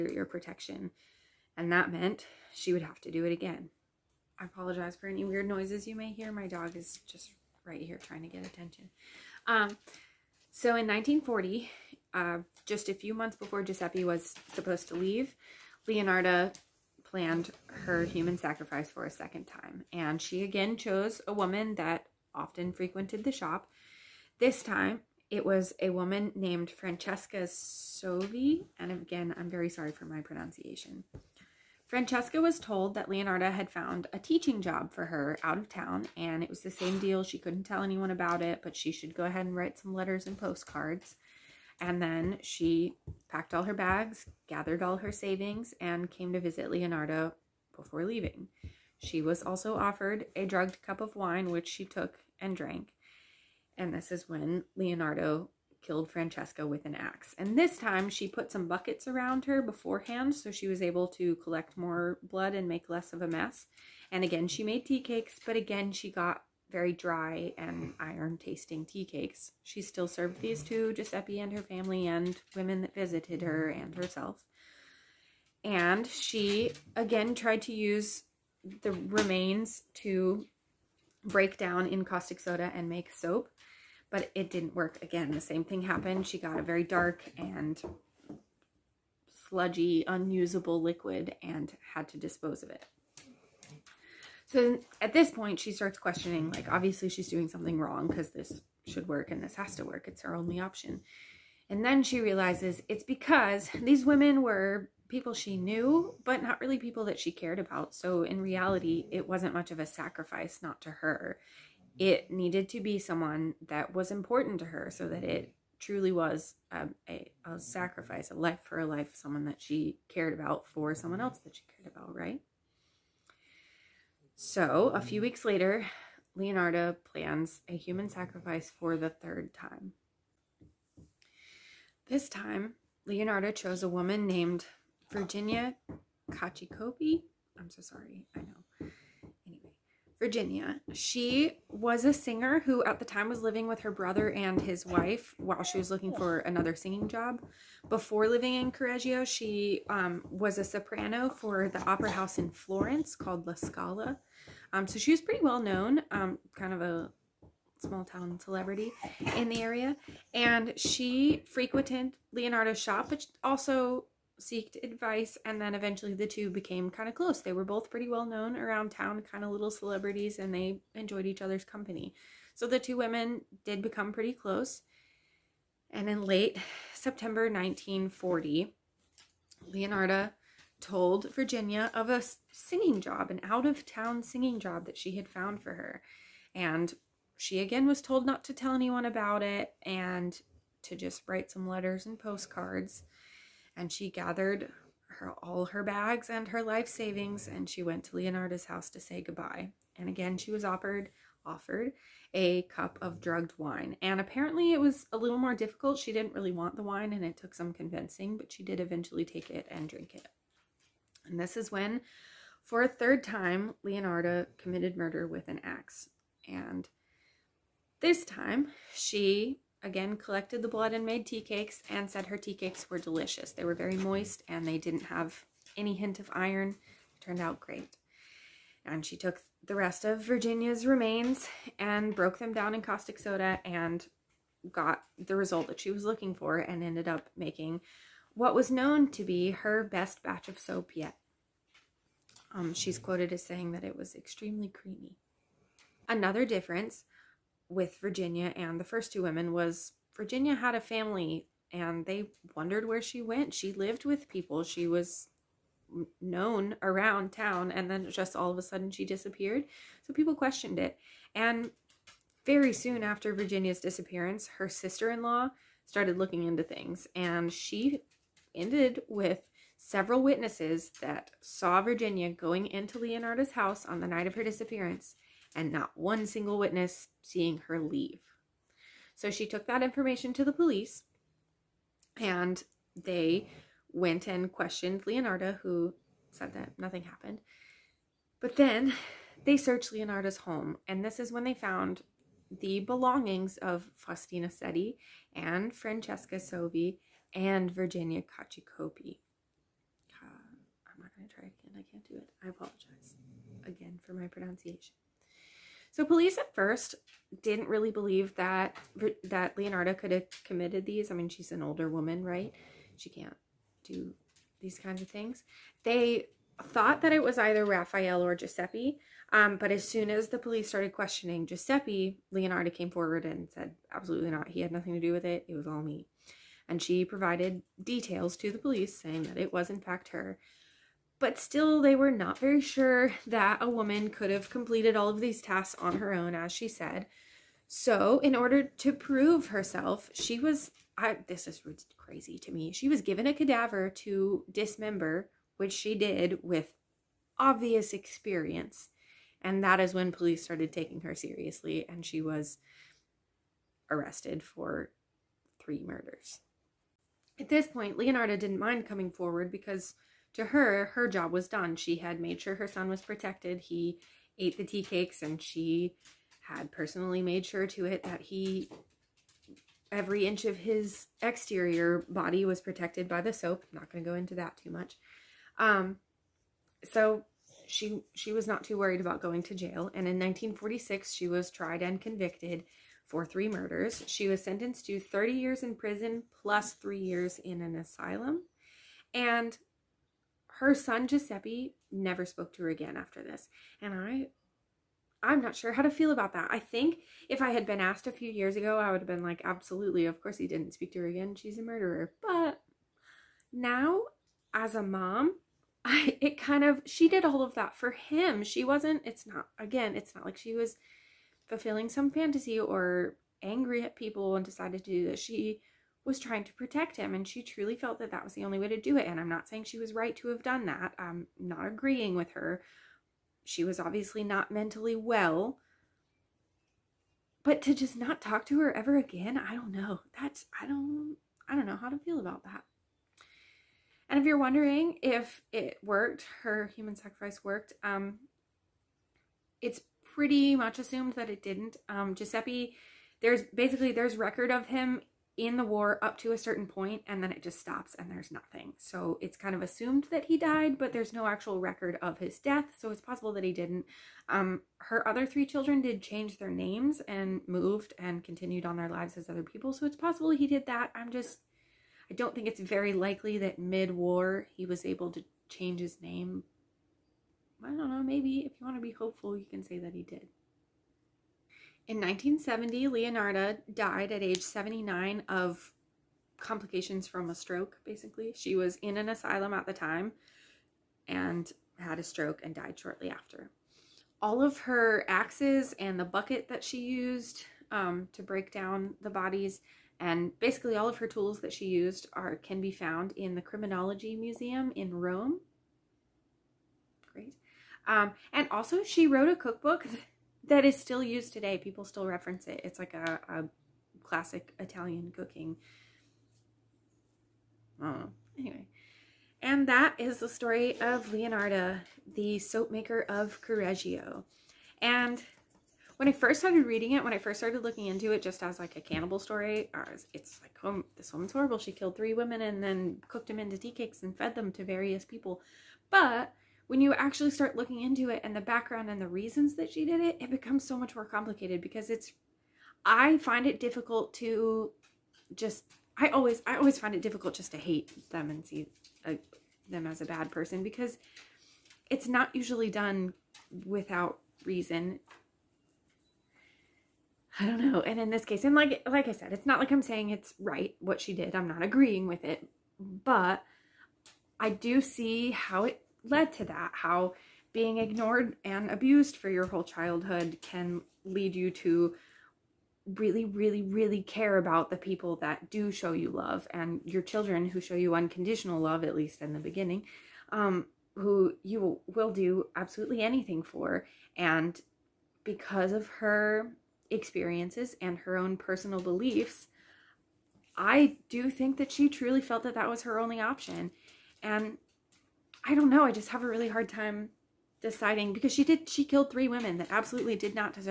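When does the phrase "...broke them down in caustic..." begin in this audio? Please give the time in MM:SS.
03:52.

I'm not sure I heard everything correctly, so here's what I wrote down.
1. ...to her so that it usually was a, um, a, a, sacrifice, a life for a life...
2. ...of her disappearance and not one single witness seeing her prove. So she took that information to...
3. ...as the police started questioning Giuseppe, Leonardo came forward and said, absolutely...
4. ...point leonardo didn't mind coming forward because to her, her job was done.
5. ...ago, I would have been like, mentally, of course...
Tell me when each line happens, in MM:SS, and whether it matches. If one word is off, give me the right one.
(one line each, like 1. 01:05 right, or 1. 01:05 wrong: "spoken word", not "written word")
1. 01:54 wrong: "truly", not "usually"
2. 04:34 wrong: "leave", not "prove"
3. 05:20 right
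4. 05:57 right
5. 06:38 wrong: "absolutely", not "mentally".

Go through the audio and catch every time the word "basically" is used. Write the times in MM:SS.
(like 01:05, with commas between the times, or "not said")
07:23, 07:57, 08:10.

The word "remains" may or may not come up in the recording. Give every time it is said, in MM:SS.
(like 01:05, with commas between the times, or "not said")
01:18, 03:50.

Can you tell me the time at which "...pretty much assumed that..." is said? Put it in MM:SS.
07:20.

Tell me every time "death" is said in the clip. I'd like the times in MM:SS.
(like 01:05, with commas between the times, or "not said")
07:32.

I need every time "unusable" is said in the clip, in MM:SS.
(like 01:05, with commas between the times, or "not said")
01:30.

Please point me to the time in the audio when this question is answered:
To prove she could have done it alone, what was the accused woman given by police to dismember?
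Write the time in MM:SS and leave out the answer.
05:43.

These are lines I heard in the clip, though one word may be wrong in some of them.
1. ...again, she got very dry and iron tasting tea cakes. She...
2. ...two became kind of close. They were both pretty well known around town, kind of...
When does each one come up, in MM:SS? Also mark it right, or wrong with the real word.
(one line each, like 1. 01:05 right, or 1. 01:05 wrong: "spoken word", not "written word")
1. 01:05 right
2. 02:46 right.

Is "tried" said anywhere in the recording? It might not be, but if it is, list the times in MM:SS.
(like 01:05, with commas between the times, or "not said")
01:17, 06:21.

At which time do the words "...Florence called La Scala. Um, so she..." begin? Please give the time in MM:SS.
02:32.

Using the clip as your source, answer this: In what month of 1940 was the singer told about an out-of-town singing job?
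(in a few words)
September.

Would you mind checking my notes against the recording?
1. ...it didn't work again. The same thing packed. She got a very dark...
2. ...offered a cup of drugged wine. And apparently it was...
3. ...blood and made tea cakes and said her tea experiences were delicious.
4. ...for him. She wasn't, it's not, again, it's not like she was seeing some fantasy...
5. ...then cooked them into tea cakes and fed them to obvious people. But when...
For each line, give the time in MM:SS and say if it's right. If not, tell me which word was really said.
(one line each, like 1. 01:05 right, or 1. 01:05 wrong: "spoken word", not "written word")
1. 01:24 wrong: "happened", not "packed"
2. 03:21 right
3. 03:40 wrong: "cakes", not "experiences"
4. 06:47 wrong: "fulfilling", not "seeing"
5. 08:42 wrong: "various", not "obvious".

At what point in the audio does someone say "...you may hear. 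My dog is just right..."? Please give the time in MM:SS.
00:05.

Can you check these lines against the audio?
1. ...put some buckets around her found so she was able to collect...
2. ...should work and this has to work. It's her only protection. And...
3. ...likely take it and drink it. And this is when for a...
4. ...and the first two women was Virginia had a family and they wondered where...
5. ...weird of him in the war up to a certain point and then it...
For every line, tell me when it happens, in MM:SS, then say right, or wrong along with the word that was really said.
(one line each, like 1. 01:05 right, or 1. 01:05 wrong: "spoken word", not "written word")
1. 00:58 wrong: "beforehand", not "found"
2. 01:38 wrong: "option", not "protection"
3. 03:28 wrong: "eventually", not "likely"
4. 04:08 right
5. 07:24 wrong: "record", not "weird".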